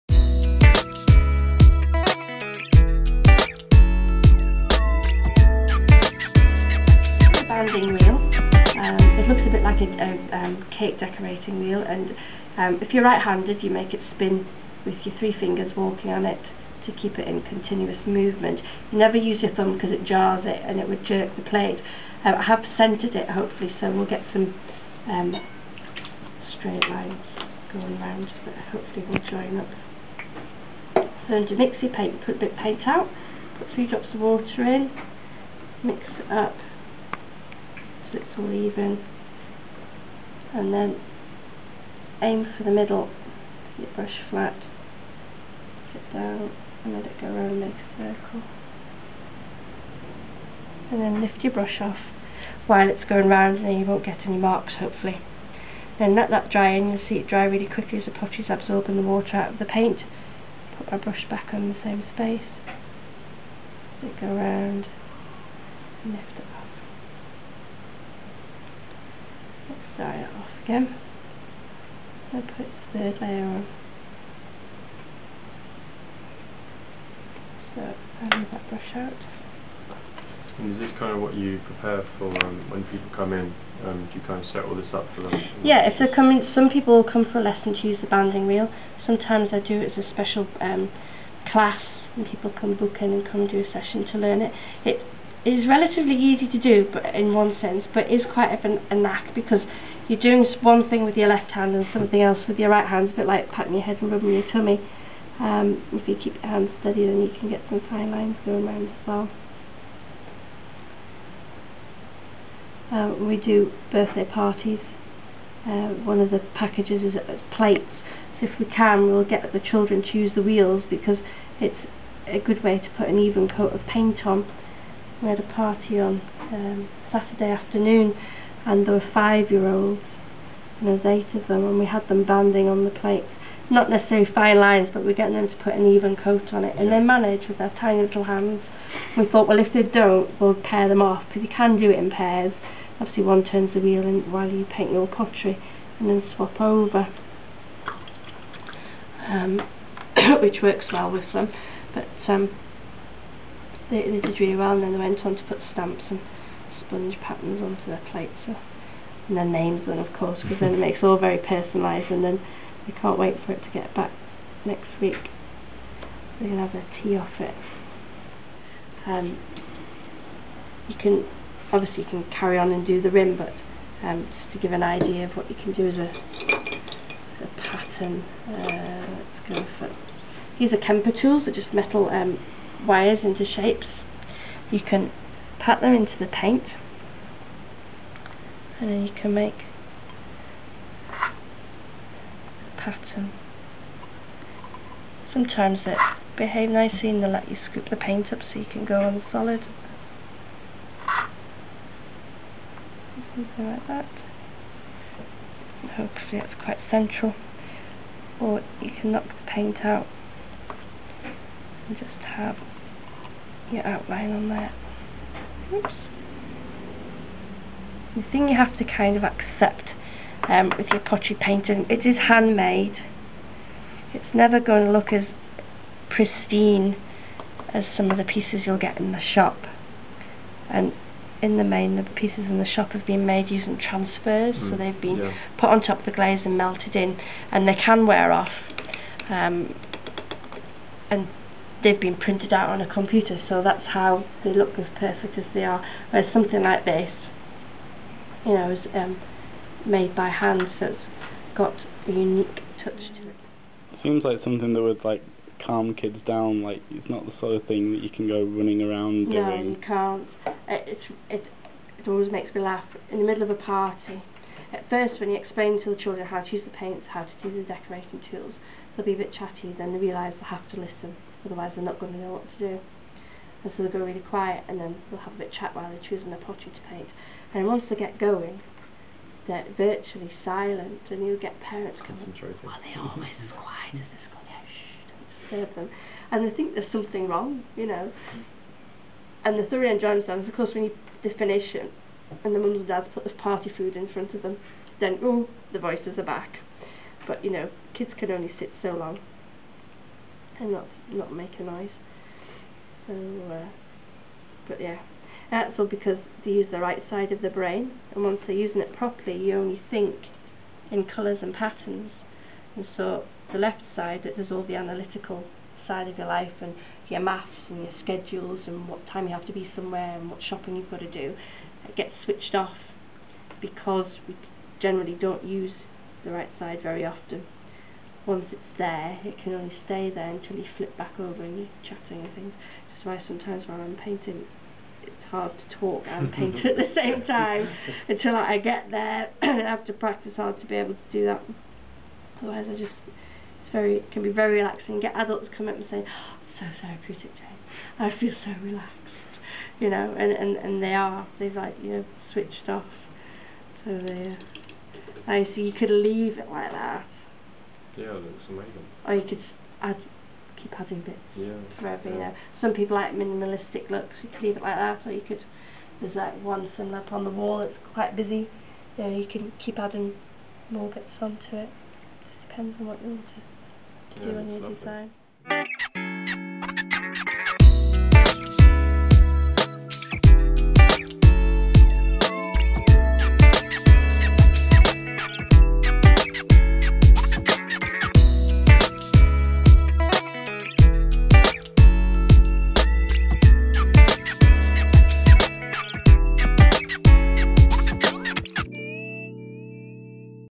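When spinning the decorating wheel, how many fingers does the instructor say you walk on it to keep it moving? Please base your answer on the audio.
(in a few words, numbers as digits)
3.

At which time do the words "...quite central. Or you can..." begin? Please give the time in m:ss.
3:26.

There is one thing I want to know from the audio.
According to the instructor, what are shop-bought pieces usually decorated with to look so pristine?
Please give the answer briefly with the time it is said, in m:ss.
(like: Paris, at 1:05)
transfers, at 3:53.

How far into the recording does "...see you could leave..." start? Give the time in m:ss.
5:55.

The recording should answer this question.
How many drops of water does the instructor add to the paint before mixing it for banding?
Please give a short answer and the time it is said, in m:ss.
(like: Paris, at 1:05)
3, at 0:33.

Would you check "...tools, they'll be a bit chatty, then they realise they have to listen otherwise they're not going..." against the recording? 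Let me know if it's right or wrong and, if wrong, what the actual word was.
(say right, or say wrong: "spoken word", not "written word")
right.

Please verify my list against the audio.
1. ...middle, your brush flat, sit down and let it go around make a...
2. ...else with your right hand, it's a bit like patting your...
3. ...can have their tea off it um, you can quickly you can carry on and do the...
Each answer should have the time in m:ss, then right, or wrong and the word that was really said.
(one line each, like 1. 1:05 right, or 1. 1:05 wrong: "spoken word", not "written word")
1. 0:42 right
2. 1:42 right
3. 2:46 wrong: "obviously", not "quickly".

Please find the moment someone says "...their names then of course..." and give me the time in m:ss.
2:39.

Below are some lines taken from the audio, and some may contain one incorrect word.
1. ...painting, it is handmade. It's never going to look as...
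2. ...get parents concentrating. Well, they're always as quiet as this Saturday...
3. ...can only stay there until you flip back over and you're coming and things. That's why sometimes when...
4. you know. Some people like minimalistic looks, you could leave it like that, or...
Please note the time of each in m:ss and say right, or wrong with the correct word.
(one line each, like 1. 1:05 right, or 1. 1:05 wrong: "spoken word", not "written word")
1. 3:41 right
2. 4:41 wrong: "Yeah", not "Saturday"
3. 5:29 wrong: "chatting", not "coming"
4. 6:02 right.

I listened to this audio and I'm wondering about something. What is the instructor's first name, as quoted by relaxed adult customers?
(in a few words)
Jane.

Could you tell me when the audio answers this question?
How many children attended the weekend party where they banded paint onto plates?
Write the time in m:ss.
2:11.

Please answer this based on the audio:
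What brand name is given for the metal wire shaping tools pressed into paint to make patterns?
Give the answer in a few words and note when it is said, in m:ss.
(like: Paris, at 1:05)
Kemper, at 3:00.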